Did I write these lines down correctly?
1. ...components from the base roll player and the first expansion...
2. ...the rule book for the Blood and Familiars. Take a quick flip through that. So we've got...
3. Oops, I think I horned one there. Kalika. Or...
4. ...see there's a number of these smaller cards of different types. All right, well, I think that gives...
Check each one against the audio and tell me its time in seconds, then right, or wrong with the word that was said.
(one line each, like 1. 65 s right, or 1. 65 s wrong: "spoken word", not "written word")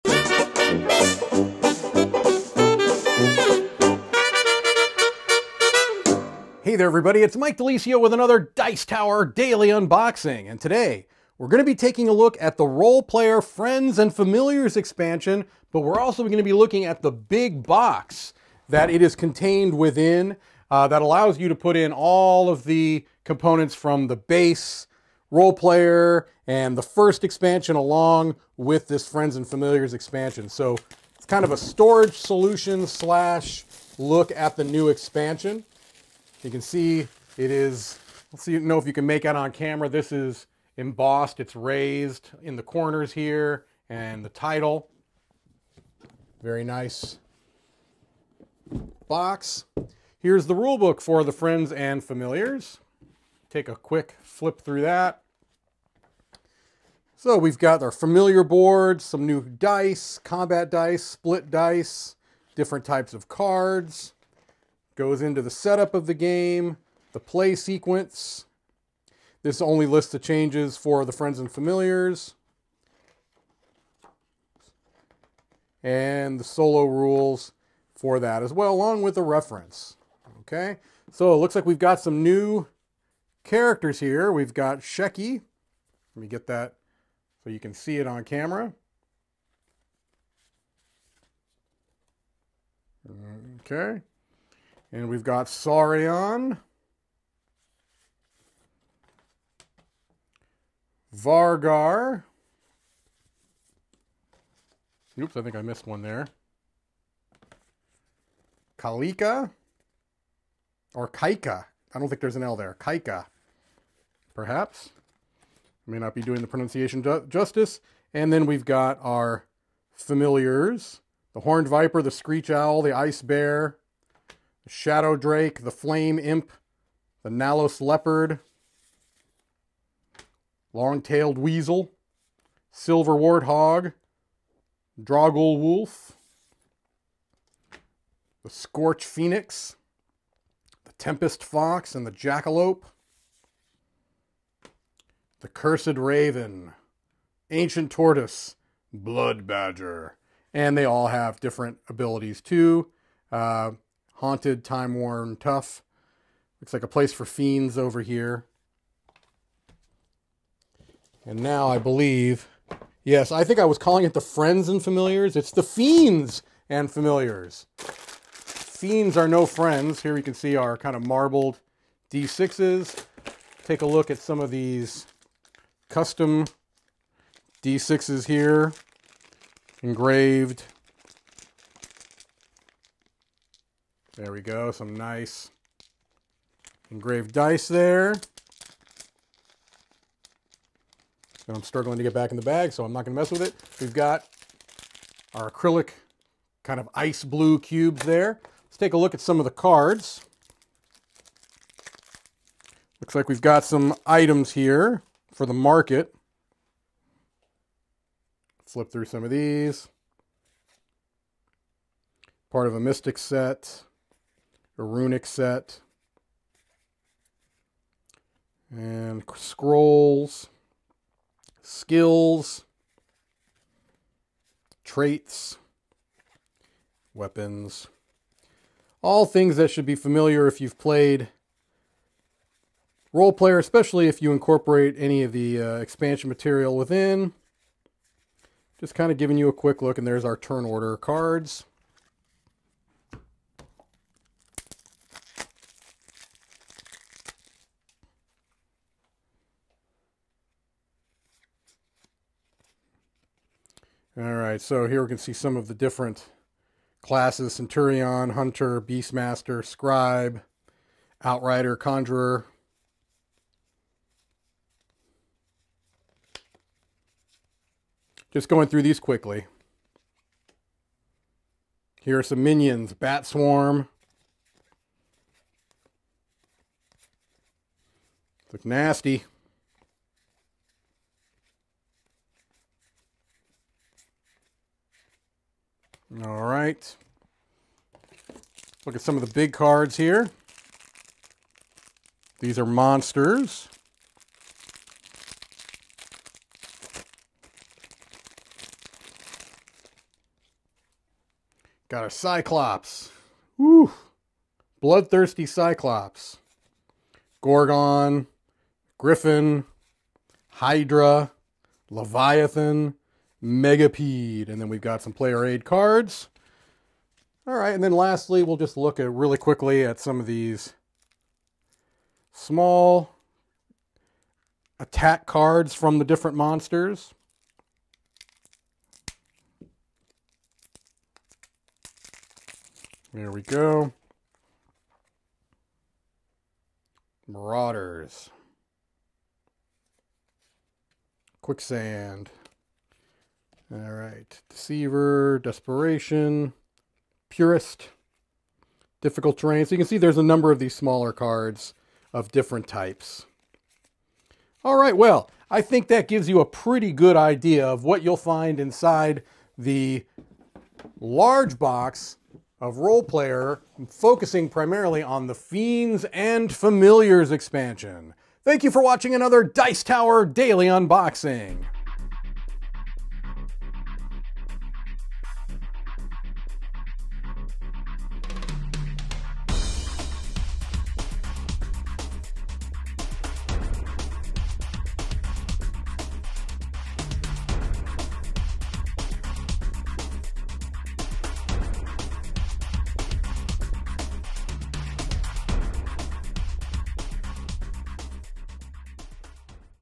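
1. 23 s right
2. 50 s wrong: "Friends", not "Blood"
3. 105 s wrong: "missed", not "horned"
4. 349 s right.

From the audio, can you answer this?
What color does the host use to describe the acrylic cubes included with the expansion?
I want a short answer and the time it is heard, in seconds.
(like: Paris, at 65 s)
ice blue, at 196 s.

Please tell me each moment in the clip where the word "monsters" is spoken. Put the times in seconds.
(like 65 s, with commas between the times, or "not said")
292 s, 326 s.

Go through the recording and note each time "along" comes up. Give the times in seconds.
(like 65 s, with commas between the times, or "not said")
27 s, 78 s.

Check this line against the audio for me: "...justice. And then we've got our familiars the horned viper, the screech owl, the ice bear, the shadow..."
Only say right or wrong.
right.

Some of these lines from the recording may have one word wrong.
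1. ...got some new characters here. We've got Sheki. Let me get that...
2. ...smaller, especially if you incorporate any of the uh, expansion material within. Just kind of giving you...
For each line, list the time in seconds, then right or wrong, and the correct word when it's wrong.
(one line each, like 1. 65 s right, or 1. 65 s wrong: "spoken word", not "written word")
1. 81 s right
2. 233 s wrong: "player", not "smaller".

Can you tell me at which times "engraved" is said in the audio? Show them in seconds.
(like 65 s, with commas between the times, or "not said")
179 s, 186 s.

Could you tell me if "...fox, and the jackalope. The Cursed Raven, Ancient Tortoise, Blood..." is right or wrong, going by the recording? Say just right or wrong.
right.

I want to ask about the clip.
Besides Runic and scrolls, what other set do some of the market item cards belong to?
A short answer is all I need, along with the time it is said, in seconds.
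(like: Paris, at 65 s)
Mystic, at 212 s.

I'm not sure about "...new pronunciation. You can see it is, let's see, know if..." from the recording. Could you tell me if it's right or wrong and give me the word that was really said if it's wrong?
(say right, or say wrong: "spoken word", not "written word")
wrong: "expansion", not "pronunciation".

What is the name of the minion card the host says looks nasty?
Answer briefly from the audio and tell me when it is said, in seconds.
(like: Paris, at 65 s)
Bat Swarm, at 272 s.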